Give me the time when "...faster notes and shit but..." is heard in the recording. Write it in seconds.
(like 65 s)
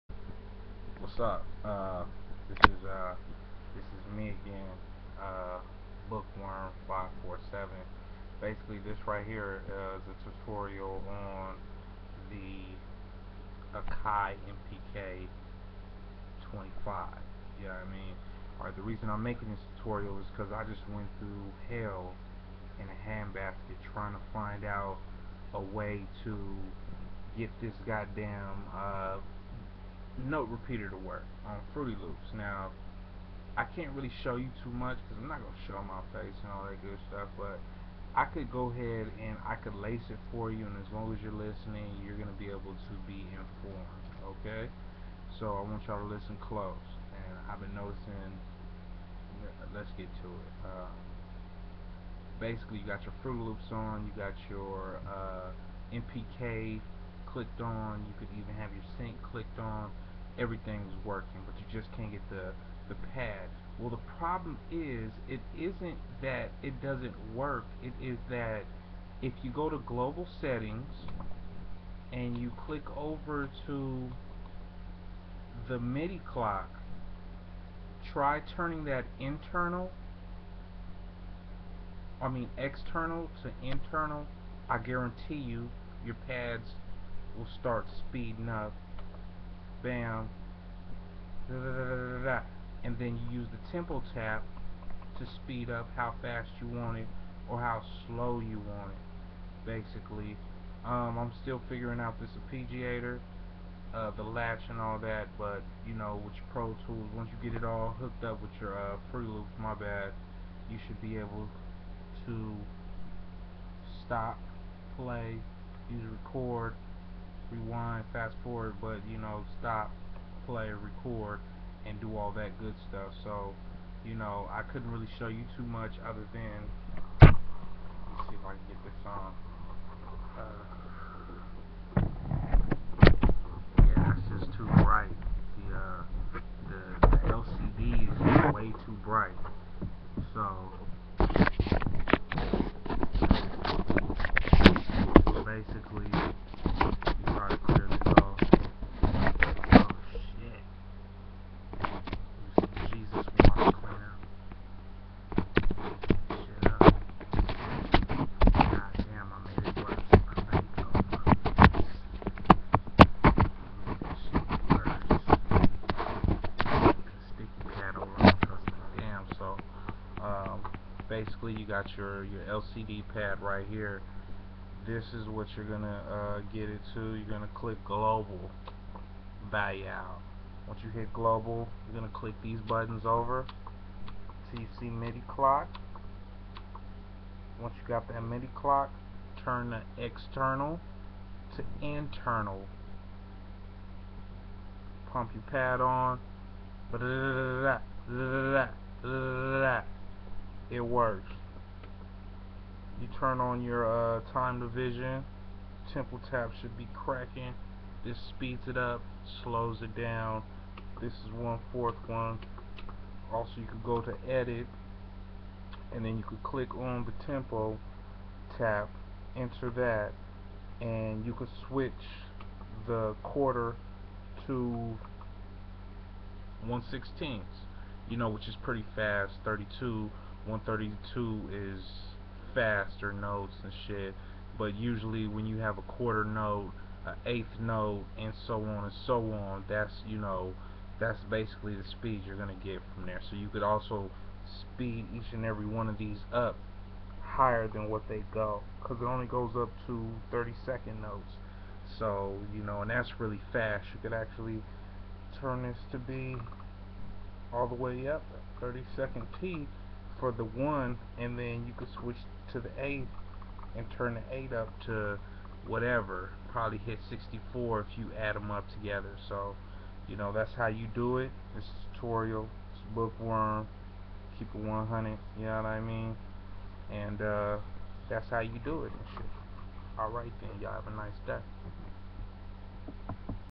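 232 s.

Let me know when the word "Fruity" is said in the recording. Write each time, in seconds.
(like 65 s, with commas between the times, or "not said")
31 s, 53 s.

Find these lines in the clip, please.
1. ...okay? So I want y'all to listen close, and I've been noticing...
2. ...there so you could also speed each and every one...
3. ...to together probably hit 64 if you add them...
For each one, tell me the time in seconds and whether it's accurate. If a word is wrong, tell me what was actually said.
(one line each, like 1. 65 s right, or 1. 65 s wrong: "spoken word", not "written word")
1. 44 s right
2. 243 s right
3. 264 s wrong: "whatever", not "together".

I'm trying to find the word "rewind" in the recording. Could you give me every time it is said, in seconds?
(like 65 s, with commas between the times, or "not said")
117 s.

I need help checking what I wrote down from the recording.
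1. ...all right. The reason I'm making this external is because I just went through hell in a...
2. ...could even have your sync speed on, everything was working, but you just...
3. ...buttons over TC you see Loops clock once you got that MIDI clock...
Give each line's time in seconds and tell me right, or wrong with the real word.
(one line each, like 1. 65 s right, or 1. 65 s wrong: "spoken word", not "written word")
1. 18 s wrong: "tutorial", not "external"
2. 58 s wrong: "clicked", not "speed"
3. 182 s wrong: "MIDI", not "Loops".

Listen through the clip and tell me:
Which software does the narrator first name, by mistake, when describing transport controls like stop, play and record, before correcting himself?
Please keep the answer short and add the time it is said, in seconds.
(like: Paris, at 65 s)
Pro Tools, at 106 s.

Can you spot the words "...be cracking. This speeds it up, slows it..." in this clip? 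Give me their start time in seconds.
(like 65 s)
206 s.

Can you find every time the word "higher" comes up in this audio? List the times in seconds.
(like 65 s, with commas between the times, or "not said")
247 s.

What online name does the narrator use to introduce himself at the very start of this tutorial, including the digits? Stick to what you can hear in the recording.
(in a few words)
Bookworm 547.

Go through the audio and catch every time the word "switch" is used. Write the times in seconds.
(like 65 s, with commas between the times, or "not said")
221 s, 261 s.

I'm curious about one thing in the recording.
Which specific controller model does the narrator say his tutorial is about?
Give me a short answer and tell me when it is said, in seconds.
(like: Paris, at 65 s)
Akai MPK 25, at 13 s.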